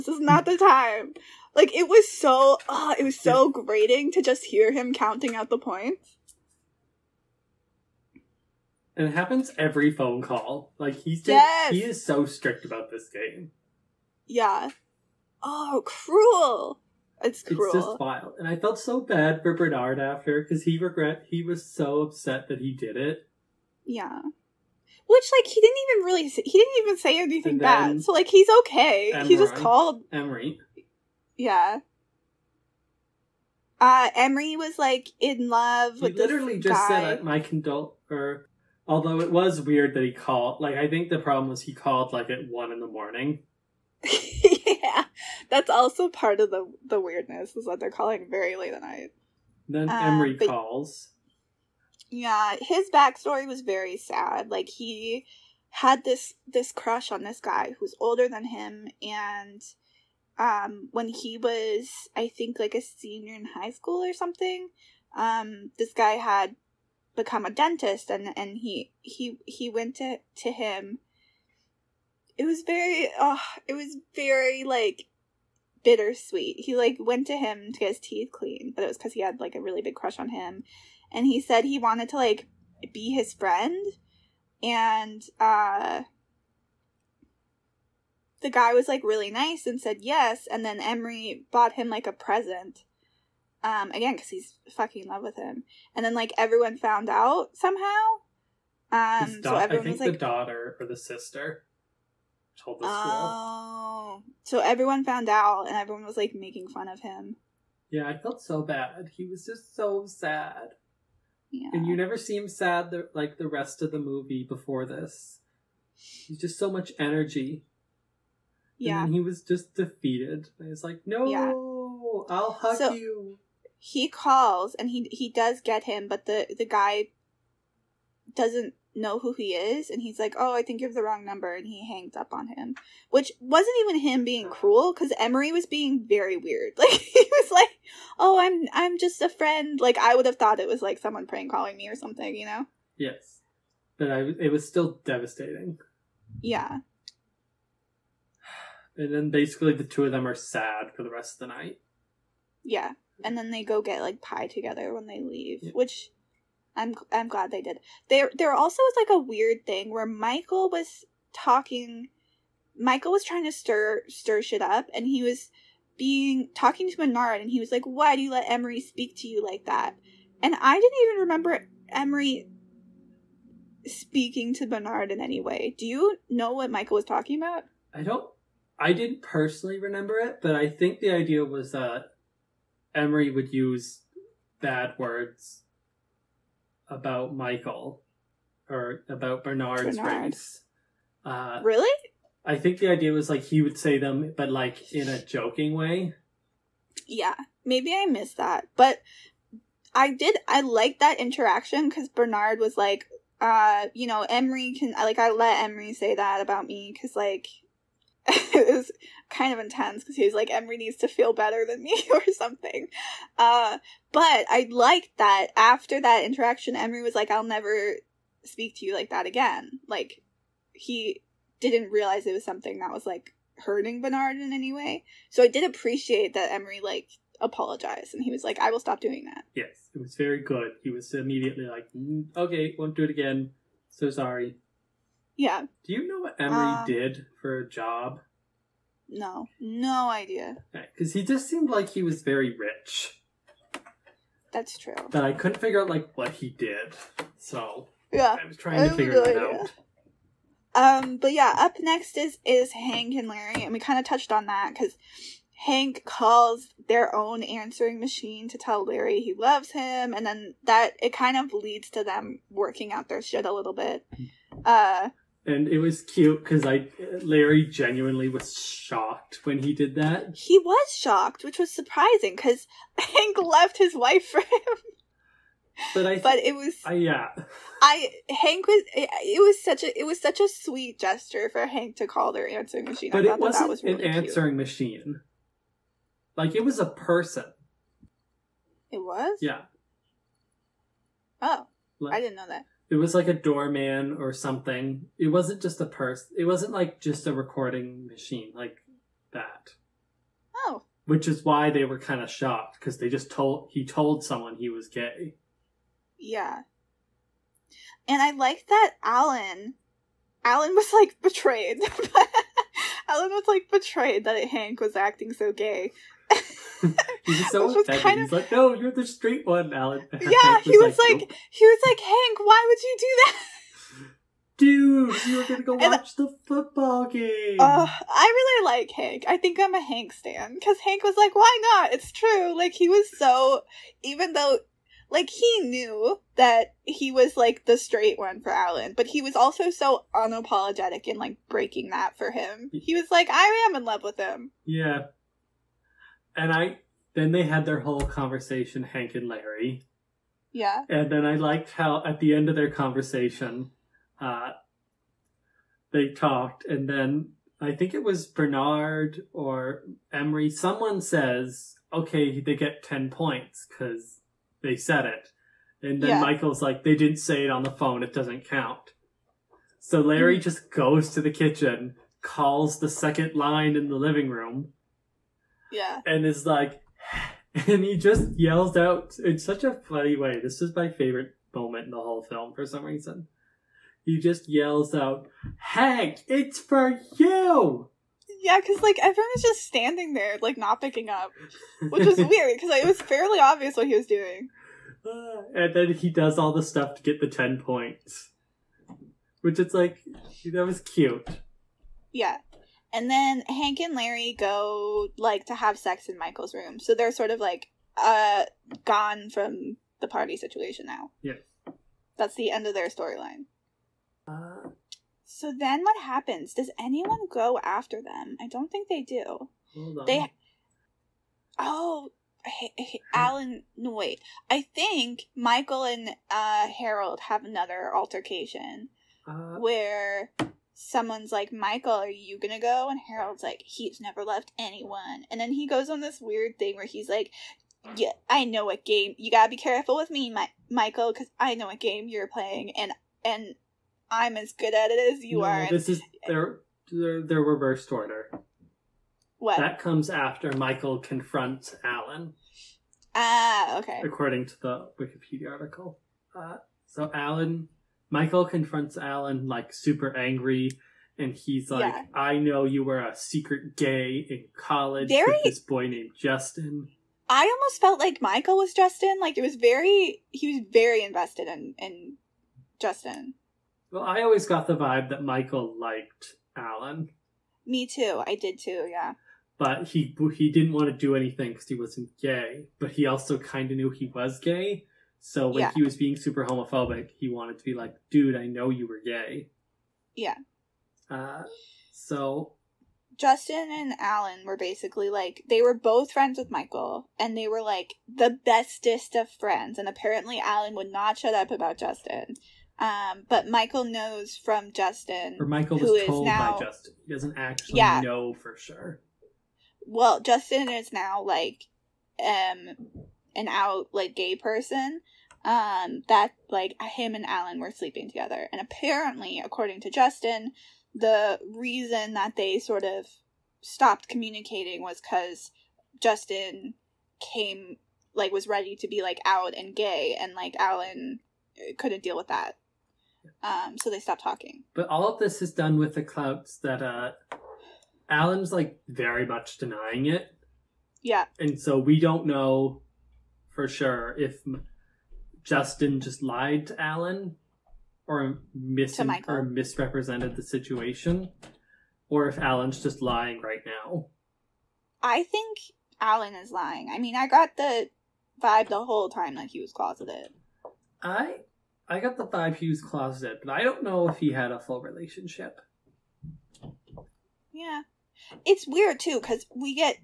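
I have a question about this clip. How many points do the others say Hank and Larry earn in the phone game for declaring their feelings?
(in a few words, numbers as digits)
10.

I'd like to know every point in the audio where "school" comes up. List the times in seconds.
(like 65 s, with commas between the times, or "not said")
63 s, 103 s.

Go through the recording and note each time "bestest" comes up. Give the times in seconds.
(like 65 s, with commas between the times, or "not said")
498 s.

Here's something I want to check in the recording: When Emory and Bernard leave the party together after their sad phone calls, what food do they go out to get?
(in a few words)
Pie.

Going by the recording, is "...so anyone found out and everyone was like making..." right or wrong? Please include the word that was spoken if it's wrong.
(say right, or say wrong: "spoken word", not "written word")
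wrong: "everyone", not "anyone".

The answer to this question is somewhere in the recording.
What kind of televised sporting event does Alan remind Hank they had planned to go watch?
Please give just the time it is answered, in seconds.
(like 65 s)
326 s.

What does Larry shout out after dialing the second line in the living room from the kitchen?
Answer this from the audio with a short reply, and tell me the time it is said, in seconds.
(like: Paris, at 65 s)
Hank, it's for you, at 385 s.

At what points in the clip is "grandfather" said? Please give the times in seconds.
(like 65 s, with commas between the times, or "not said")
not said.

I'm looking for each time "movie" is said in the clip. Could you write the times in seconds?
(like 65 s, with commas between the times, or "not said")
113 s.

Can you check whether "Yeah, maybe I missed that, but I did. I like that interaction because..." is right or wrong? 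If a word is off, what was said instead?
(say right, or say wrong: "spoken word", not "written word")
right.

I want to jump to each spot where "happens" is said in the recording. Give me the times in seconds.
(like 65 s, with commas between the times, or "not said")
9 s, 416 s.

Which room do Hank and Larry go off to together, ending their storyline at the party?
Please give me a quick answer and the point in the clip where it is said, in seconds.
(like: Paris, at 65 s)
Michael's room, at 406 s.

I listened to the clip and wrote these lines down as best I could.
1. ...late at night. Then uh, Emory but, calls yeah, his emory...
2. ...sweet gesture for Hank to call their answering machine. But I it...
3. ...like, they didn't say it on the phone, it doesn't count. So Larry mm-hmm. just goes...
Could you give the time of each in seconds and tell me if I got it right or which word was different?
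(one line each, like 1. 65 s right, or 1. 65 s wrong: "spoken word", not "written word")
1. 48 s wrong: "backstory", not "emory"
2. 280 s right
3. 366 s right.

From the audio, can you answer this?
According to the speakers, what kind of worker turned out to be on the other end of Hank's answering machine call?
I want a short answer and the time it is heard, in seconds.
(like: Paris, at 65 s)
Doorman, at 293 s.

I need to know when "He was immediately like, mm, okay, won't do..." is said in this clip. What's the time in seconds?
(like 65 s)
230 s.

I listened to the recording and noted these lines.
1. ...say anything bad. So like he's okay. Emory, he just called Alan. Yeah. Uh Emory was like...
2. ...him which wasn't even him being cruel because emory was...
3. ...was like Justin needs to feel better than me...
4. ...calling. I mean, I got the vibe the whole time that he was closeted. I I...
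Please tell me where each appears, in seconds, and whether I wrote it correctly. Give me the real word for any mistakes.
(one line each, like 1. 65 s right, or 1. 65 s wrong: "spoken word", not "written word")
1. 26 s wrong: "Emory", not "Alan"
2. 132 s right
3. 210 s wrong: "Emory", not "Justin"
4. 556 s wrong: "lying", not "calling".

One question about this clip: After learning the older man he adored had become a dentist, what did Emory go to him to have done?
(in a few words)
Get his teeth cleaned.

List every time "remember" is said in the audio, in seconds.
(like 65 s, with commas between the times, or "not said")
171 s, 179 s.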